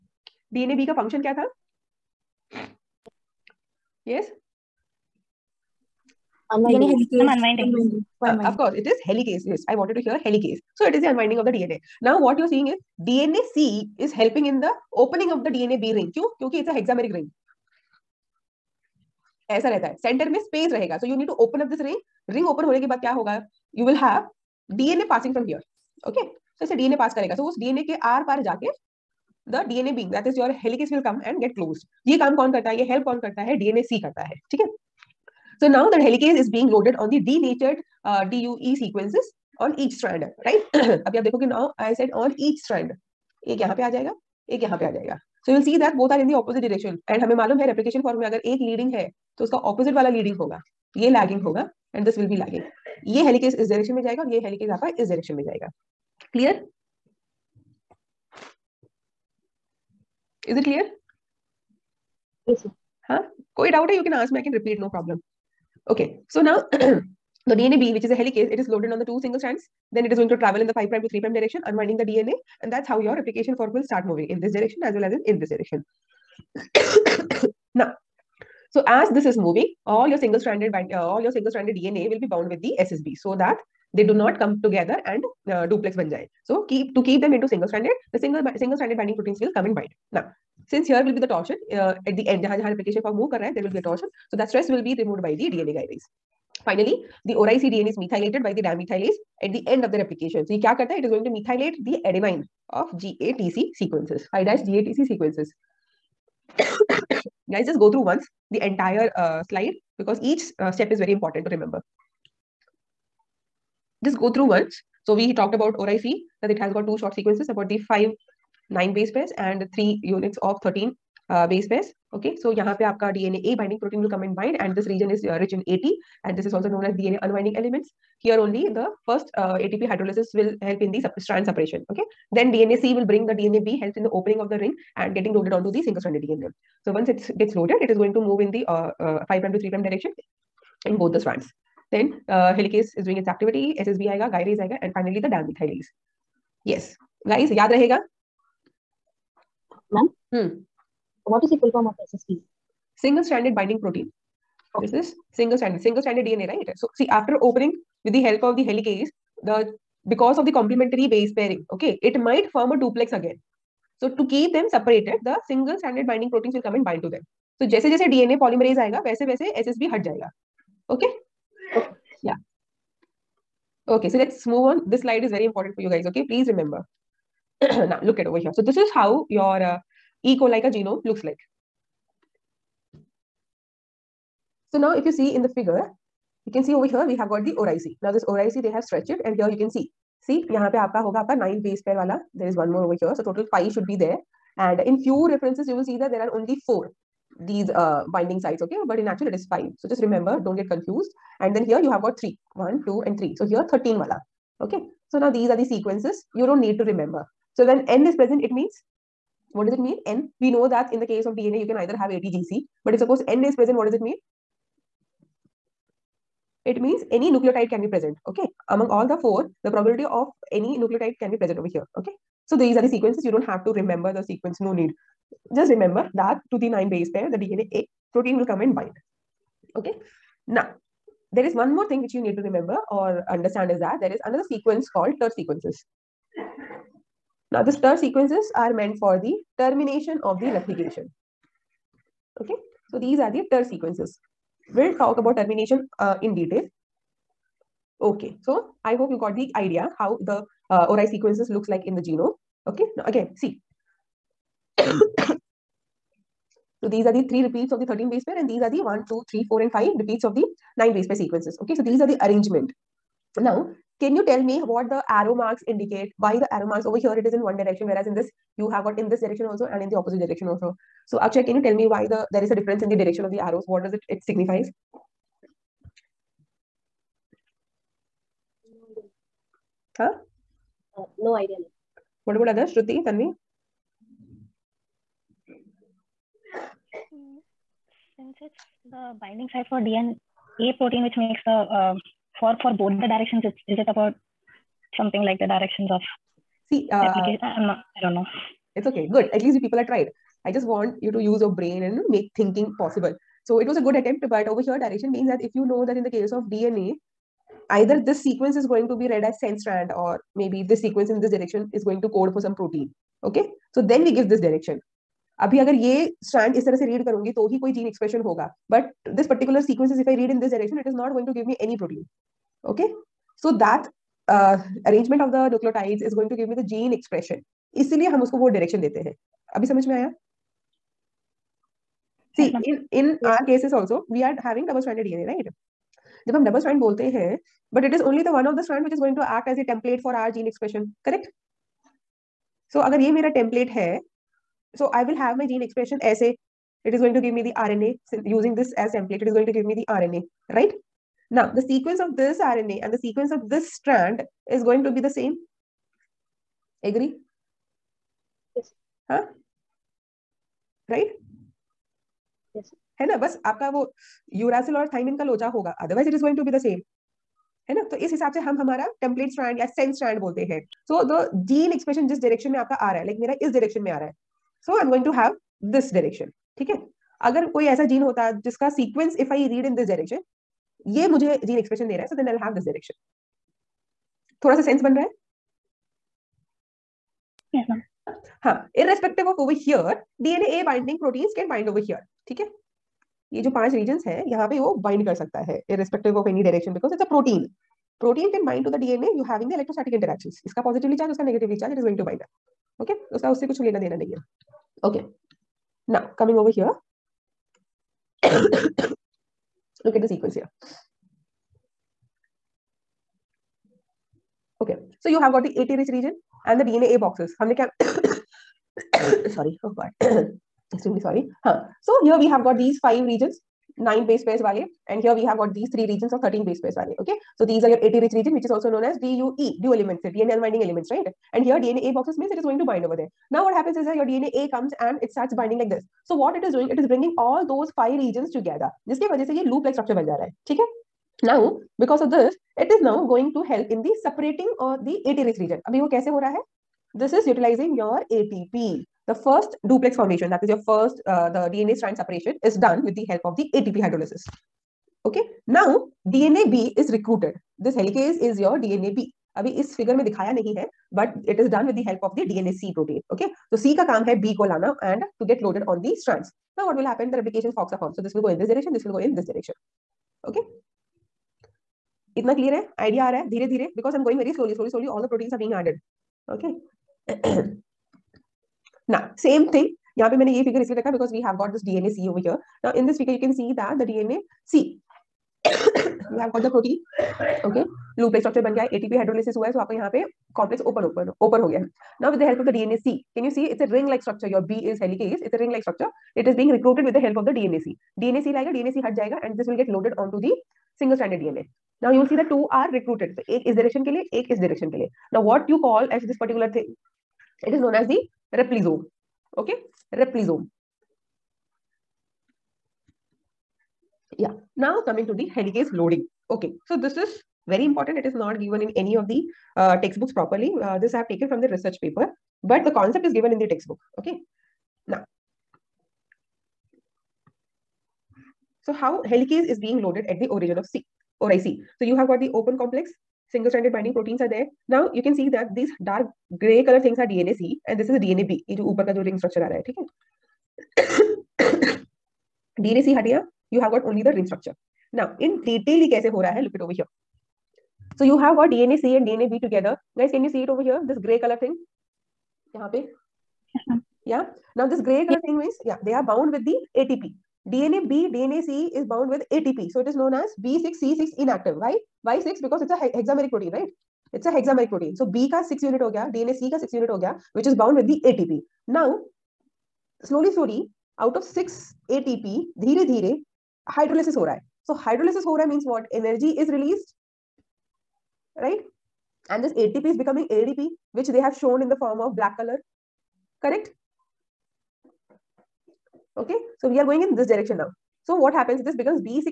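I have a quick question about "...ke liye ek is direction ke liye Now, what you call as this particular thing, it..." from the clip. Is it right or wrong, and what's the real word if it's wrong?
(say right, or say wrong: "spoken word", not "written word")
right.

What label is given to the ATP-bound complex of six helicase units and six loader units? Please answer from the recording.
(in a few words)
B6C6 inactive.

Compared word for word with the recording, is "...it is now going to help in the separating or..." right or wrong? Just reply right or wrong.
right.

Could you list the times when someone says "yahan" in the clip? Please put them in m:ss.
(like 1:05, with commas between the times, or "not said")
2:02, 9:12.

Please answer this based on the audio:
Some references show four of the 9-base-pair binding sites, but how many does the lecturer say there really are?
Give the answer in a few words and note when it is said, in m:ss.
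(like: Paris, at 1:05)
5, at 3:19.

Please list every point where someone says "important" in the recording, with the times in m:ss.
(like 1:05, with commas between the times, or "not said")
1:51, 2:55, 8:37.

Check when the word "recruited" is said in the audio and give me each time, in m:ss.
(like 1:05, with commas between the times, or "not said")
7:36, 8:16, 8:22.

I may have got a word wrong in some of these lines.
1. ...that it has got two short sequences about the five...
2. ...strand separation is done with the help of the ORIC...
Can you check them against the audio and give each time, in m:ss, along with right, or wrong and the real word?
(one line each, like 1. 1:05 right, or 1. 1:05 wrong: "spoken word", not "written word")
1. 1:56 right
2. 7:31 wrong: "ATP", not "ORIC".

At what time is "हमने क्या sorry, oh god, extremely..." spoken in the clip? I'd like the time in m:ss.
6:57.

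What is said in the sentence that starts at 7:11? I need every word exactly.
And here DNA A boxes means it is going to bind over there.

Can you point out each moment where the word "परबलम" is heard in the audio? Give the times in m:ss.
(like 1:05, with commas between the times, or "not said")
1:04.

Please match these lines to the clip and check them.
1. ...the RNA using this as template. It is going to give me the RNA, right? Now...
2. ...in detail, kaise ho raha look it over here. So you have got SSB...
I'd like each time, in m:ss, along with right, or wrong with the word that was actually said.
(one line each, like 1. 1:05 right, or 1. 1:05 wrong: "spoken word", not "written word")
1. 5:47 right
2. 9:05 wrong: "DNA", not "SSB".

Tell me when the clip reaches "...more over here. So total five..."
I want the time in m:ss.
3:12.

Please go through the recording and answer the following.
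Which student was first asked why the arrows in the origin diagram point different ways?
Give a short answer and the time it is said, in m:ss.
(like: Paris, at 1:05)
Akshay, at 4:31.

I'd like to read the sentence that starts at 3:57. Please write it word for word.
Now, these TER sequences are meant for the termination of the replication.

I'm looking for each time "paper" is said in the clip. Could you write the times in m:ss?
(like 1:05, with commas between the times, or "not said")
8:41.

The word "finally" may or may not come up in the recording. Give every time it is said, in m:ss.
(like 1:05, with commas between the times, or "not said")
1:36, 2:24.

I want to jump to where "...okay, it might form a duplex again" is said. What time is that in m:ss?
2:41.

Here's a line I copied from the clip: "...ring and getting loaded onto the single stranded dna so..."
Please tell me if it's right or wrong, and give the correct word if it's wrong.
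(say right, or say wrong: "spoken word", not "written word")
right.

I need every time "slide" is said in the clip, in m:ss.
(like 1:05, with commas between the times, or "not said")
1:49, 2:55.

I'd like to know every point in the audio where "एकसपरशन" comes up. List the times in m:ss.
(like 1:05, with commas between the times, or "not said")
5:17, 5:26, 5:40, 5:45, 6:11, 6:21.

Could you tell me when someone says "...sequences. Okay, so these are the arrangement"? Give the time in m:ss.
4:21.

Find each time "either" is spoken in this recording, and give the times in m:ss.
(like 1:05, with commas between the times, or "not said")
3:31, 5:07.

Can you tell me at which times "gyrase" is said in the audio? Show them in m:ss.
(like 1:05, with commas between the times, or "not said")
1:35, 2:24.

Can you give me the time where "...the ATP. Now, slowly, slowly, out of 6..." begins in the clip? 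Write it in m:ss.
9:27.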